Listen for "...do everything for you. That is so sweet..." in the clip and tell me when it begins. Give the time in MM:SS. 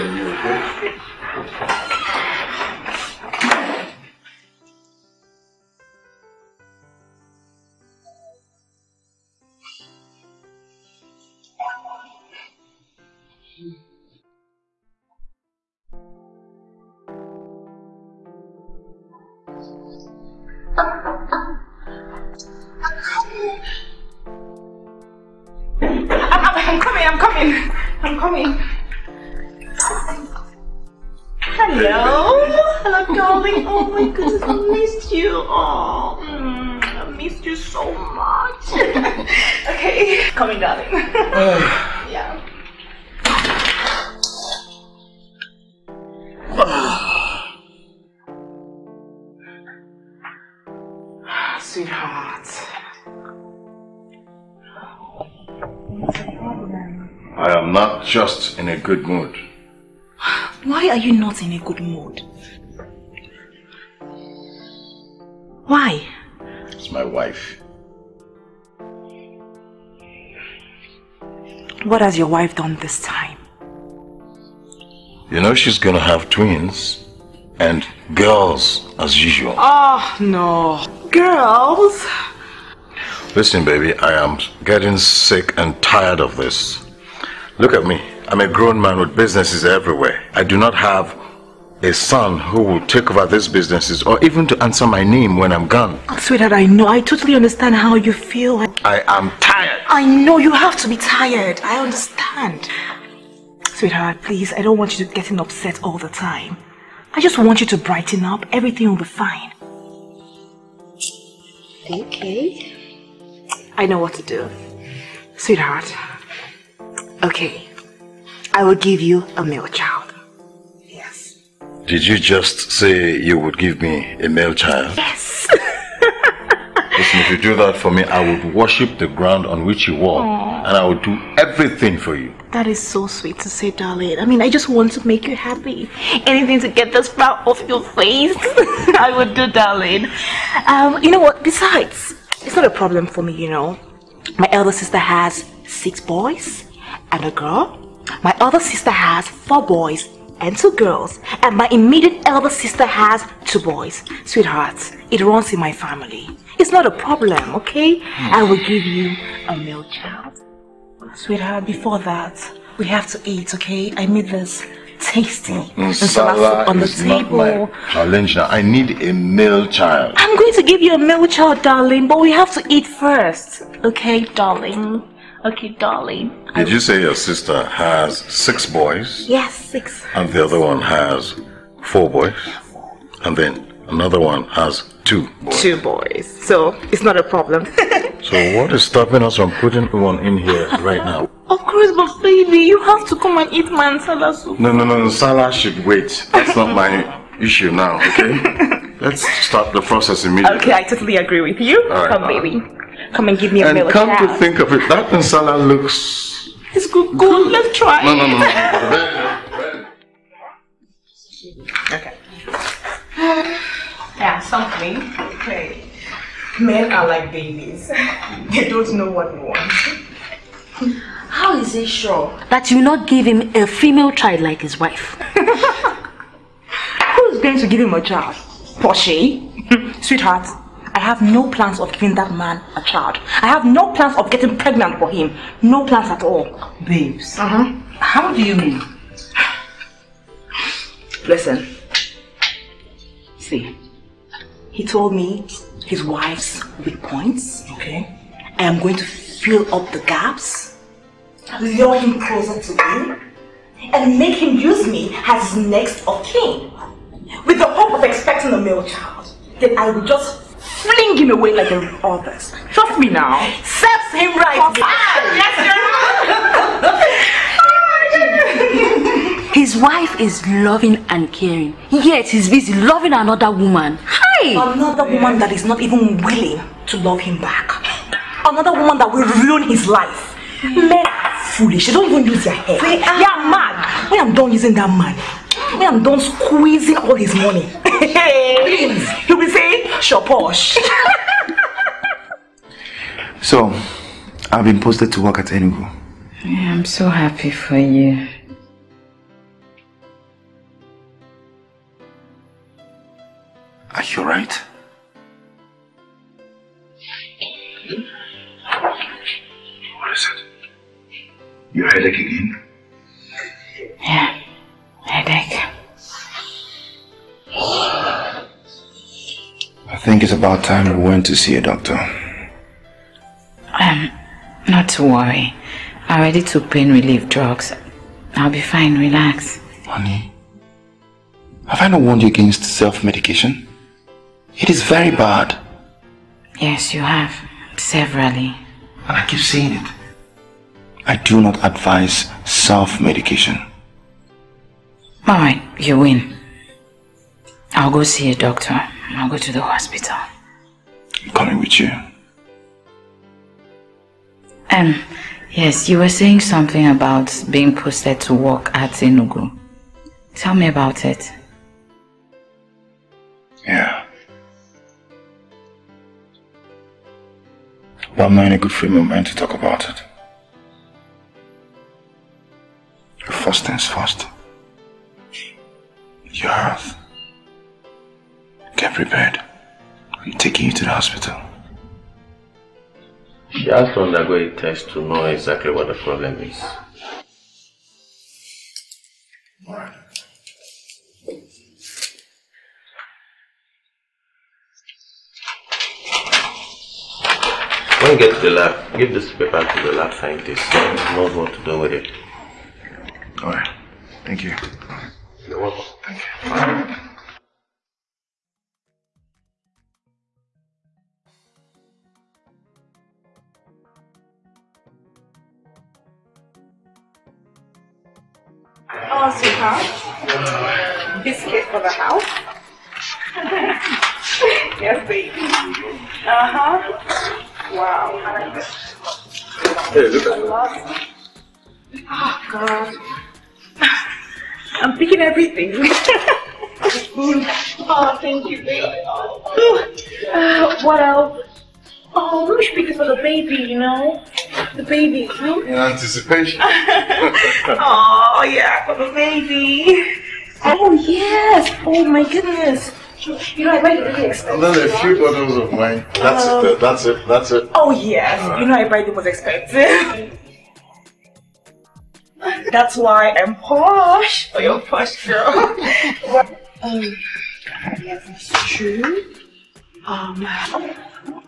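02:11.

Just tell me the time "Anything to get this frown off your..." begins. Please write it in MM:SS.
02:16.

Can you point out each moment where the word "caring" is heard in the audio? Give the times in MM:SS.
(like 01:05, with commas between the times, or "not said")
04:31.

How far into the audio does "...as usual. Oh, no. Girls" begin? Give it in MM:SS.
01:18.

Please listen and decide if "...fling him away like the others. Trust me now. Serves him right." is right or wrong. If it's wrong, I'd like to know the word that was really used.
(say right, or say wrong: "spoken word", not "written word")
right.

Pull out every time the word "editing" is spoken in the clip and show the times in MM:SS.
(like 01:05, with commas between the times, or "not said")
not said.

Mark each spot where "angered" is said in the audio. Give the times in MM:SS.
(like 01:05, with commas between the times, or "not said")
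not said.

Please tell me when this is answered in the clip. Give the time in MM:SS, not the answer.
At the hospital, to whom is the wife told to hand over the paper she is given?
06:39.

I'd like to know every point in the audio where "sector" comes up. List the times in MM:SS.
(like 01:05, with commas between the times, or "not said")
not said.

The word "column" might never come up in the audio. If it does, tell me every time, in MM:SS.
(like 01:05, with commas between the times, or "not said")
not said.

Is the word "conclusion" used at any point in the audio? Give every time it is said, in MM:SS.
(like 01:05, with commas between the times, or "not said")
not said.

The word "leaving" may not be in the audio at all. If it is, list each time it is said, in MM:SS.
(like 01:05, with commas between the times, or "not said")
not said.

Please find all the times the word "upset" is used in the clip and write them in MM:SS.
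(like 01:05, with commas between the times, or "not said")
01:45.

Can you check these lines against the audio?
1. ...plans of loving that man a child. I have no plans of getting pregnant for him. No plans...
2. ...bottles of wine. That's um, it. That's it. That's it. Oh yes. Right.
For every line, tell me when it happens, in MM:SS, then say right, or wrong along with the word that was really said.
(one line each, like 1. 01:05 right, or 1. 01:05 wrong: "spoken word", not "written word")
1. 03:51 wrong: "giving", not "loving"
2. 07:35 right.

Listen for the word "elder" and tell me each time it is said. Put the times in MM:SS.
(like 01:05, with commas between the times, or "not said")
02:24, 02:32.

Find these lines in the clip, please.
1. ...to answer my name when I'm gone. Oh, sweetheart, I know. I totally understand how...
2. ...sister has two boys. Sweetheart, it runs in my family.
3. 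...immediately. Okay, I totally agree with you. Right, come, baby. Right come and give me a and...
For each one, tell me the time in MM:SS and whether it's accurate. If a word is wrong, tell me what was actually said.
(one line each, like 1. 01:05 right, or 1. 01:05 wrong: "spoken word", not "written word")
1. 01:34 right
2. 02:32 right
3. 03:20 right.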